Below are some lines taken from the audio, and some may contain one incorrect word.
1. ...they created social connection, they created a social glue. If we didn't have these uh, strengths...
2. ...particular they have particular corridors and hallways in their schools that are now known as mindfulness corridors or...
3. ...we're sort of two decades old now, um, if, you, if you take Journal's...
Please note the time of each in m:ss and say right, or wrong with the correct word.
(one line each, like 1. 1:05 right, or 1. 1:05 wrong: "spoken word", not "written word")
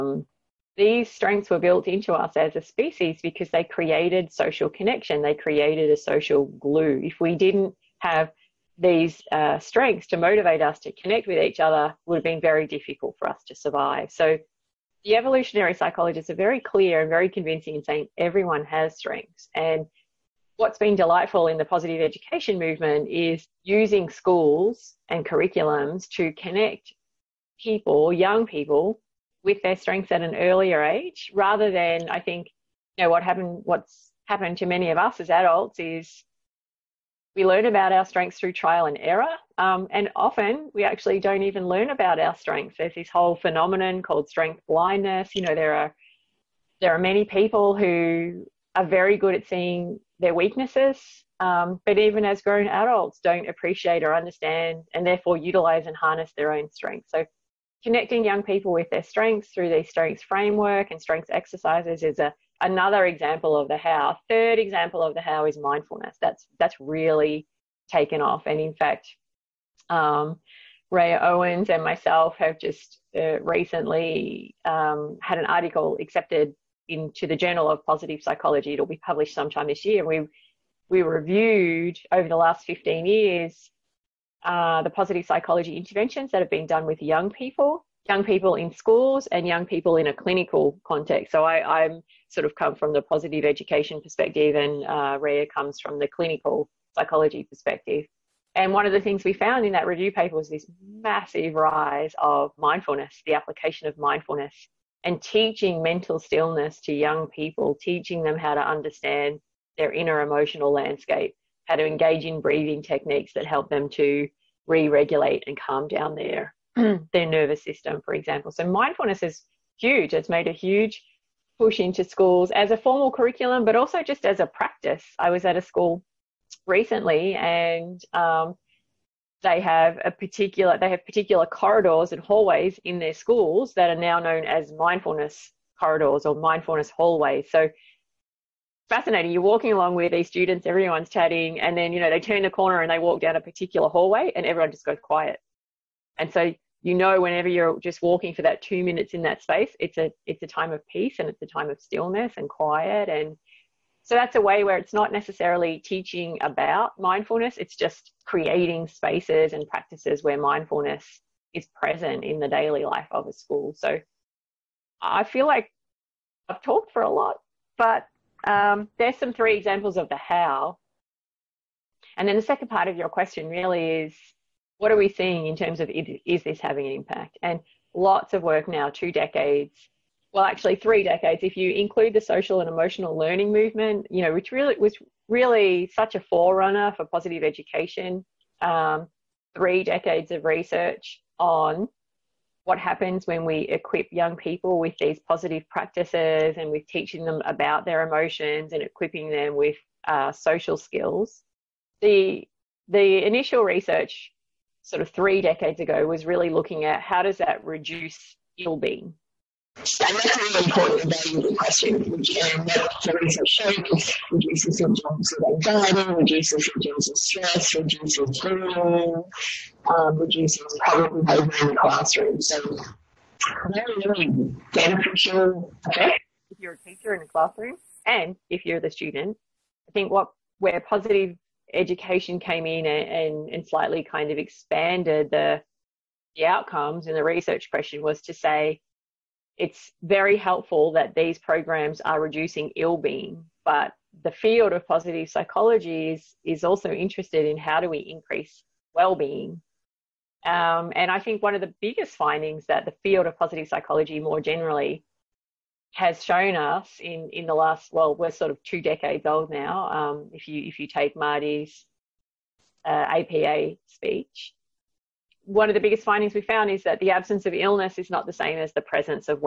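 1. 0:03 right
2. 2:10 right
3. 4:18 wrong: "Marty", not "Journal".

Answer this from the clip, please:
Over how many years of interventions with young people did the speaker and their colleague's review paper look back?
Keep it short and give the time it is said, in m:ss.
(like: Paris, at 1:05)
15, at 1:22.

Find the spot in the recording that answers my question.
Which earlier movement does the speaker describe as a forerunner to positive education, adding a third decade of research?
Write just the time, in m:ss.
3:02.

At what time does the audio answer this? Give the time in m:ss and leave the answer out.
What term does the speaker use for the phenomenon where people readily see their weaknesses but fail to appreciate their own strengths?
0:44.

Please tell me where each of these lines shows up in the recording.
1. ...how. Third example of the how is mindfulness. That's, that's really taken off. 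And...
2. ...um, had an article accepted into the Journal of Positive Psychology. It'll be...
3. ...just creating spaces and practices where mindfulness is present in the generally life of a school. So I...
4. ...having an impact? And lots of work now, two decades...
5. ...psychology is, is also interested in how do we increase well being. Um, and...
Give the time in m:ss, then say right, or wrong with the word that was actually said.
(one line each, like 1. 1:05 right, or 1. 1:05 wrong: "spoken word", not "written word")
1. 1:03 right
2. 1:14 right
3. 2:37 wrong: "daily", not "generally"
4. 2:56 right
5. 4:05 right.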